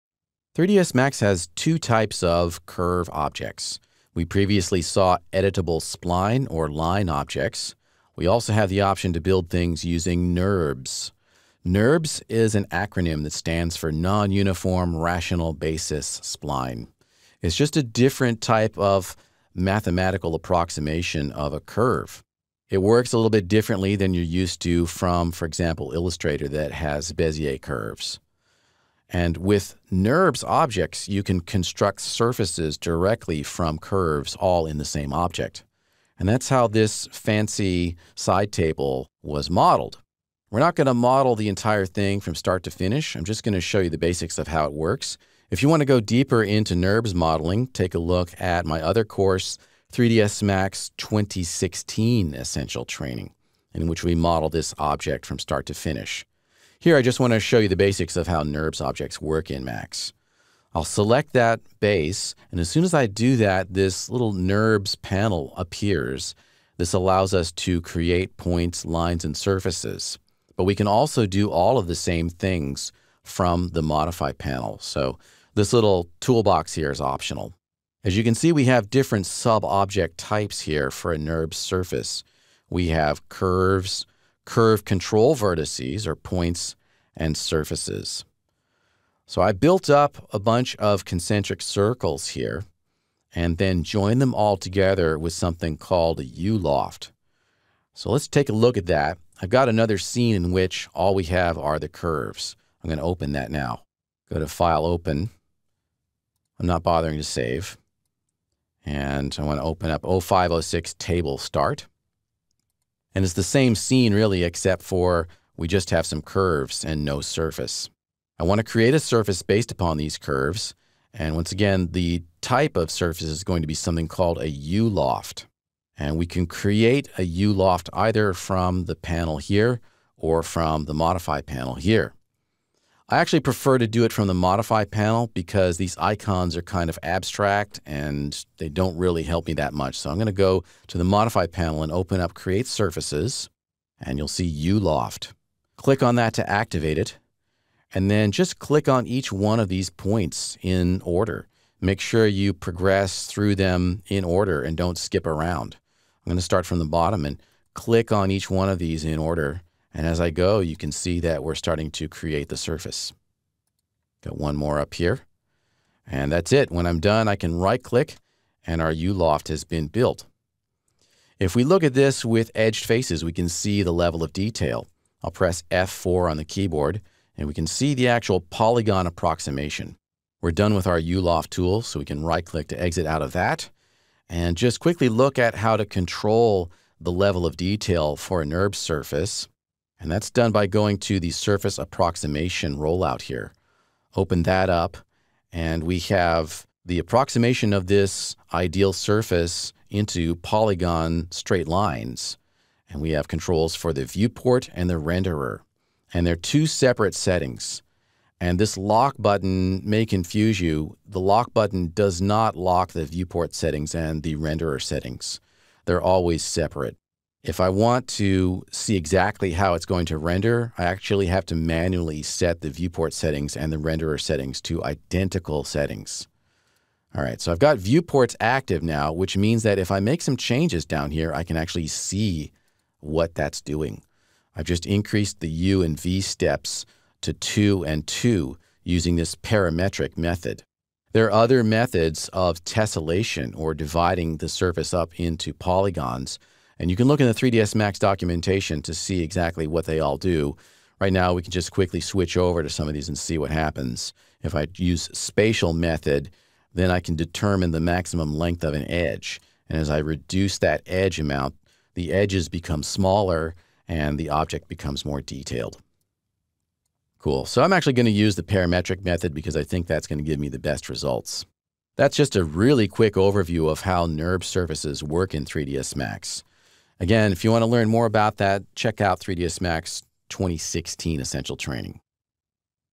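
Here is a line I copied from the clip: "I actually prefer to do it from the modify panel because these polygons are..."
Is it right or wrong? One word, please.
wrong.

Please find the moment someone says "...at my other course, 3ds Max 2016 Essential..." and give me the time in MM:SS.
00:48.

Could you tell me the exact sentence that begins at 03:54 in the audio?
I've just increased the U and V steps to 2 and 2 using this parametric method.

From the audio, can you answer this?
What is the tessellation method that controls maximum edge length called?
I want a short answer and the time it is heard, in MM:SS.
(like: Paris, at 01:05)
spatial method, at 04:15.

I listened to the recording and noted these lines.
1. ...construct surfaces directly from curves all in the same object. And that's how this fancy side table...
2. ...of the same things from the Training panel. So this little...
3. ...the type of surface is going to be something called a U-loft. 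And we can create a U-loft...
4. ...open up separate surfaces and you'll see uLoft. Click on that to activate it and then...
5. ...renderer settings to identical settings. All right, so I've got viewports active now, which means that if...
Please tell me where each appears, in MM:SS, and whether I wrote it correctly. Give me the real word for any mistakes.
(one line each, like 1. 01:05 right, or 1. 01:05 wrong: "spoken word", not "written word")
1. 00:31 right
2. 01:11 wrong: "Modify", not "Training"
3. 02:01 right
4. 02:21 wrong: "create", not "separate"
5. 03:43 right.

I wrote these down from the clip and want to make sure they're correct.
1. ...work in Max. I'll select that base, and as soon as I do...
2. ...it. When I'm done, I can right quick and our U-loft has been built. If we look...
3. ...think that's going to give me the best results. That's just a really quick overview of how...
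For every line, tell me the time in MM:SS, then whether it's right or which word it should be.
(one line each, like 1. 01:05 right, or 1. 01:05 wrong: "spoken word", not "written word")
1. 00:59 right
2. 02:46 wrong: "click", not "quick"
3. 04:29 right.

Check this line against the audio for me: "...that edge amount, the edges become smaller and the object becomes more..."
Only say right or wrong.
right.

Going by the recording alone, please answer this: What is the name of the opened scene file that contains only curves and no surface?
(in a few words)
0506 Table Start.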